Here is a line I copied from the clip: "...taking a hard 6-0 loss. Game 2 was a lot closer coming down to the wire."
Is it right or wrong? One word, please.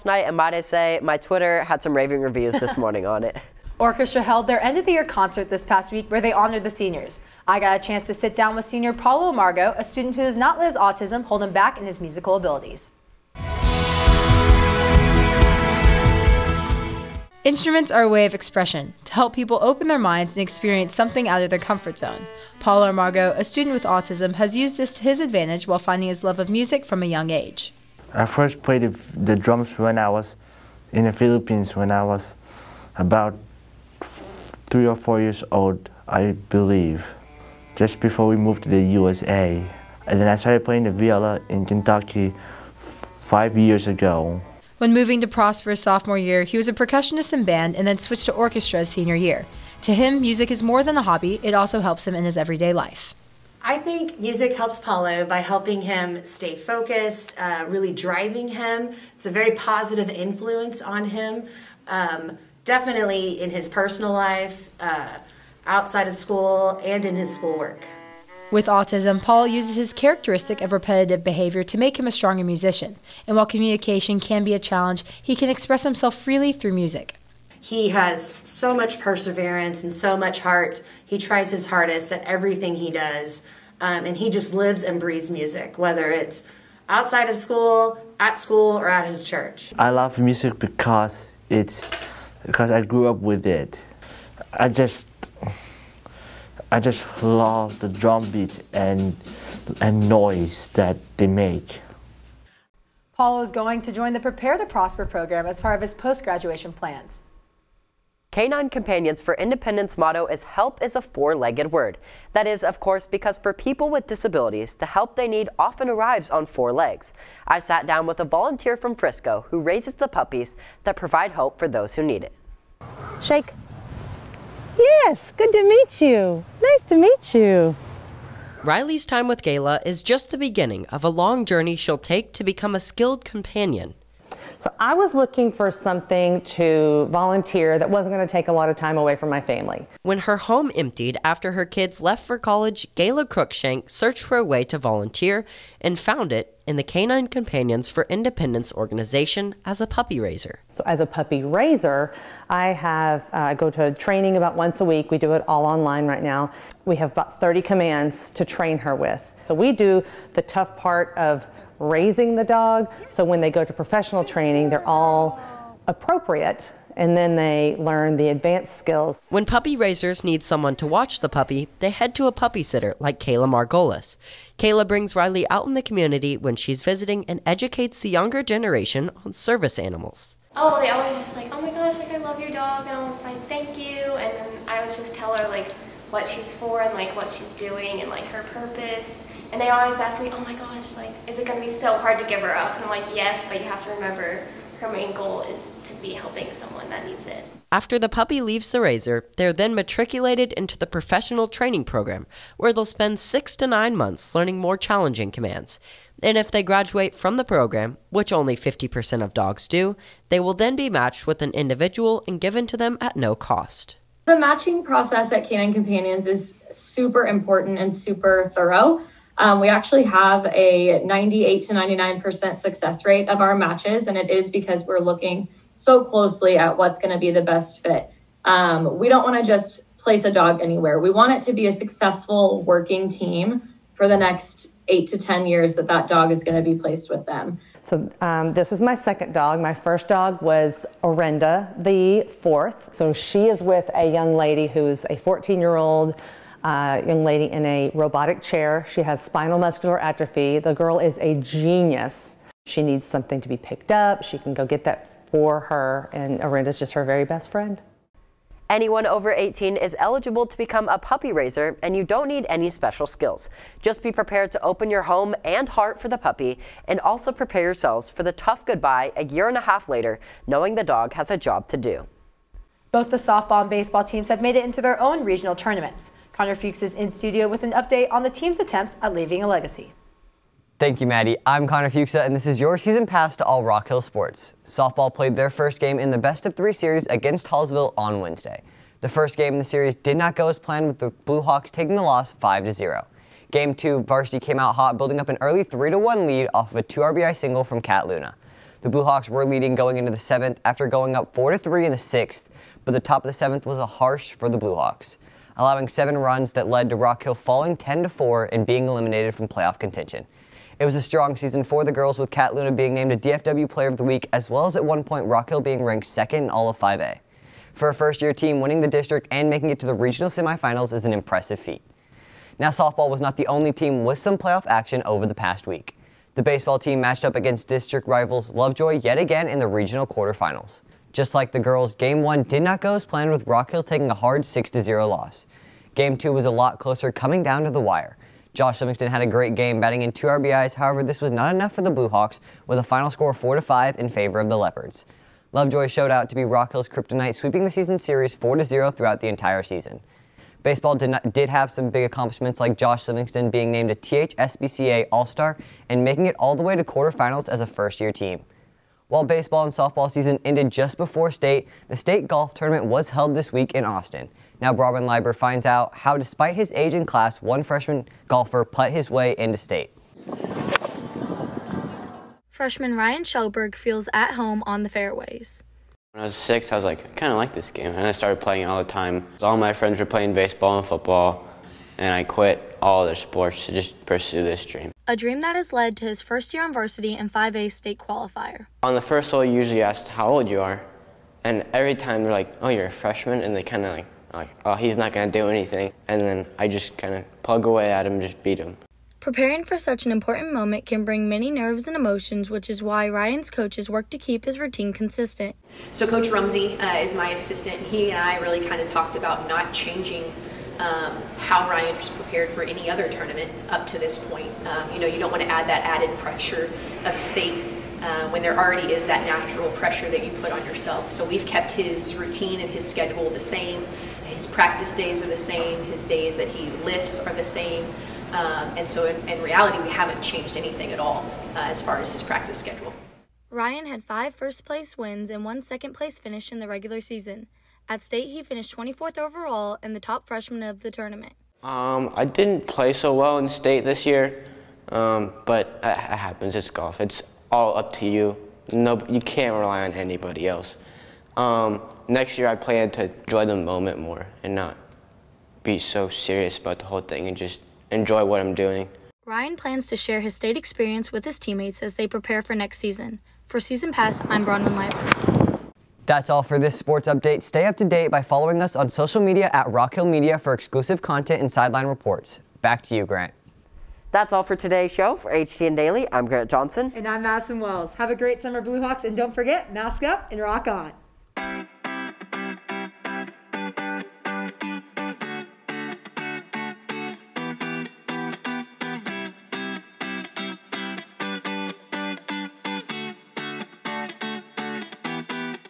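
right.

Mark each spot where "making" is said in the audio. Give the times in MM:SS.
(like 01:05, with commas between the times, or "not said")
05:19, 05:56.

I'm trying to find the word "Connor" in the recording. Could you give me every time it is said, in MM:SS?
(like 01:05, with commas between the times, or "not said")
04:36, 04:41.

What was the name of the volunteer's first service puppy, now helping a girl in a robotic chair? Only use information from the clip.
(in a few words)
Orenda.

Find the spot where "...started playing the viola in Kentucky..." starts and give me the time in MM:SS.
00:40.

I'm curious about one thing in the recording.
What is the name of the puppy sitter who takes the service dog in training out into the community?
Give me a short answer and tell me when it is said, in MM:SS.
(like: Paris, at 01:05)
Kayla Margolis, at 02:53.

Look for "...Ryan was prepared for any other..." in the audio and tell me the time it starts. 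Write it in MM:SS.
06:51.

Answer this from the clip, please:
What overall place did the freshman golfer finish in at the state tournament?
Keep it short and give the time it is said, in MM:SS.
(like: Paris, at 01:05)
24th, at 07:18.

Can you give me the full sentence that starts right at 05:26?
The baseball team matched up against district rivals Lovejoy yet again in the regional quarterfinals.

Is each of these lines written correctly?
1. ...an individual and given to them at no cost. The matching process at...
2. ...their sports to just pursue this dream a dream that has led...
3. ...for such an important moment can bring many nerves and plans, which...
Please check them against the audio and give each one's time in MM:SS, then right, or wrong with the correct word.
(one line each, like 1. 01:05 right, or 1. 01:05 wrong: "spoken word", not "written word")
1. 03:31 right
2. 06:23 right
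3. 06:39 wrong: "emotions", not "plans".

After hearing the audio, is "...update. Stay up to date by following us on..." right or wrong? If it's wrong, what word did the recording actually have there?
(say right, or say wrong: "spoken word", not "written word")
right.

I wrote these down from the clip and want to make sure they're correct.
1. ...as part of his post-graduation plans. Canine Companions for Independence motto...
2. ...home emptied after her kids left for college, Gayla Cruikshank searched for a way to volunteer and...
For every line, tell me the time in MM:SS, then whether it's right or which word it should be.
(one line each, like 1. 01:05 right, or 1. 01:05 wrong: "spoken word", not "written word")
1. 01:45 right
2. 02:20 right.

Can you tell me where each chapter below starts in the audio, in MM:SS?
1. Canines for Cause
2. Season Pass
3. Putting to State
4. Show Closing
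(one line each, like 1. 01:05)
1. 01:47
2. 04:32
3. 05:59
4. 07:52.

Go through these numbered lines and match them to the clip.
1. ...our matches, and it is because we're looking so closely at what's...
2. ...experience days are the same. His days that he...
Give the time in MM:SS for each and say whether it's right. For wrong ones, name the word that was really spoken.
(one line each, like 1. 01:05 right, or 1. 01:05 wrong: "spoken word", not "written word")
1. 03:43 right
2. 07:04 wrong: "practice", not "experience".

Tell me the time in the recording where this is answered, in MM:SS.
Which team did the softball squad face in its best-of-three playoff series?
04:47.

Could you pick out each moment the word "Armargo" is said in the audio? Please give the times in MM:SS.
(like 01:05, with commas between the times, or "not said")
00:22.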